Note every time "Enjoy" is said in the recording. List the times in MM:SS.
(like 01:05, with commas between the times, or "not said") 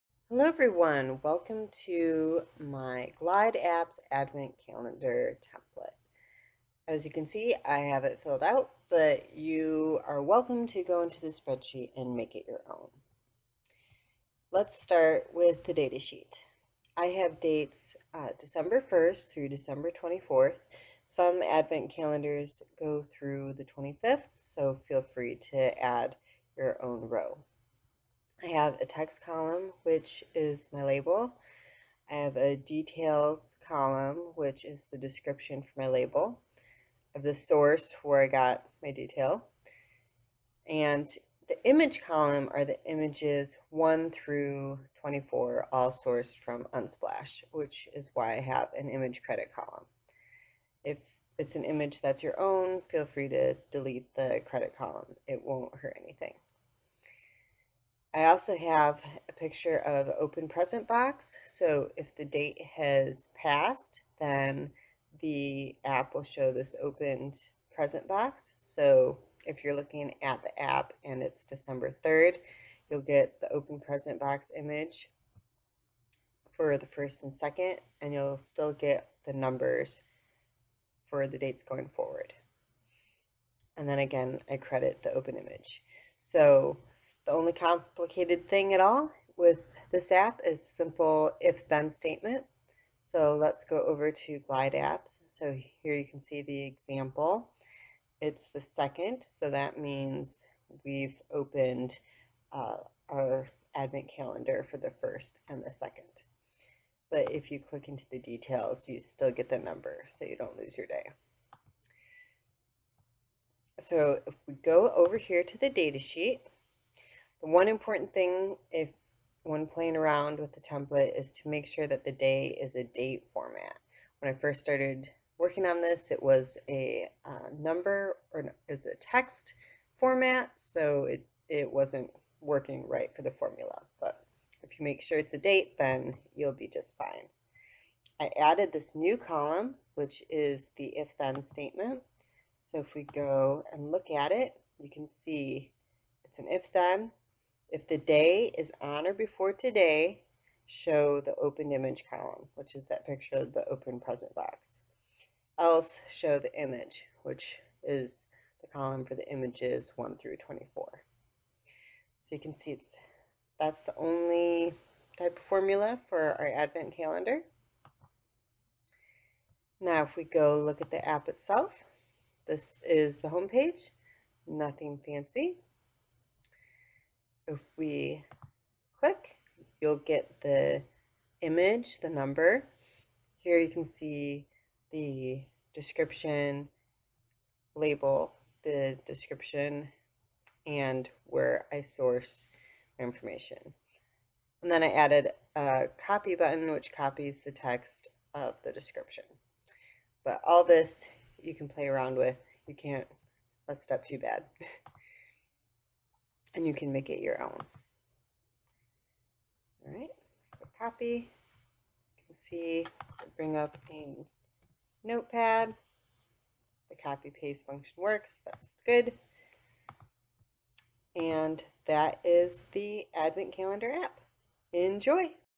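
03:44.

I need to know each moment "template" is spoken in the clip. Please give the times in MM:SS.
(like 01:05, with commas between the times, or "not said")
00:05, 02:00.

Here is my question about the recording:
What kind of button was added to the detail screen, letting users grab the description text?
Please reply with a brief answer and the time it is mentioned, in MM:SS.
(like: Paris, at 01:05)
copy button, at 03:16.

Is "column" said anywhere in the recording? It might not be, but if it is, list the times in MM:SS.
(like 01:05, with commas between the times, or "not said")
00:29, 00:33, 00:42, 00:49, 00:54, 02:19, 02:32, 02:38.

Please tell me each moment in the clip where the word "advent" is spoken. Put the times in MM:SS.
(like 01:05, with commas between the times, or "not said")
00:04, 00:21, 01:43, 02:46, 03:43.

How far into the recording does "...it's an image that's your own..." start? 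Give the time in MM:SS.
00:51.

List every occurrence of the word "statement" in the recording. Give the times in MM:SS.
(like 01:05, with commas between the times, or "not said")
01:31, 02:21.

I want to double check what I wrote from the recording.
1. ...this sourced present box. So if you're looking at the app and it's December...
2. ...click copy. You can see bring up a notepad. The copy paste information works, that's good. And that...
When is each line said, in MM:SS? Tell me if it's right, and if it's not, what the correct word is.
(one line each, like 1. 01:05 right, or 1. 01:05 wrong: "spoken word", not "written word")
1. 01:06 wrong: "opened", not "sourced"
2. 03:30 wrong: "function", not "information".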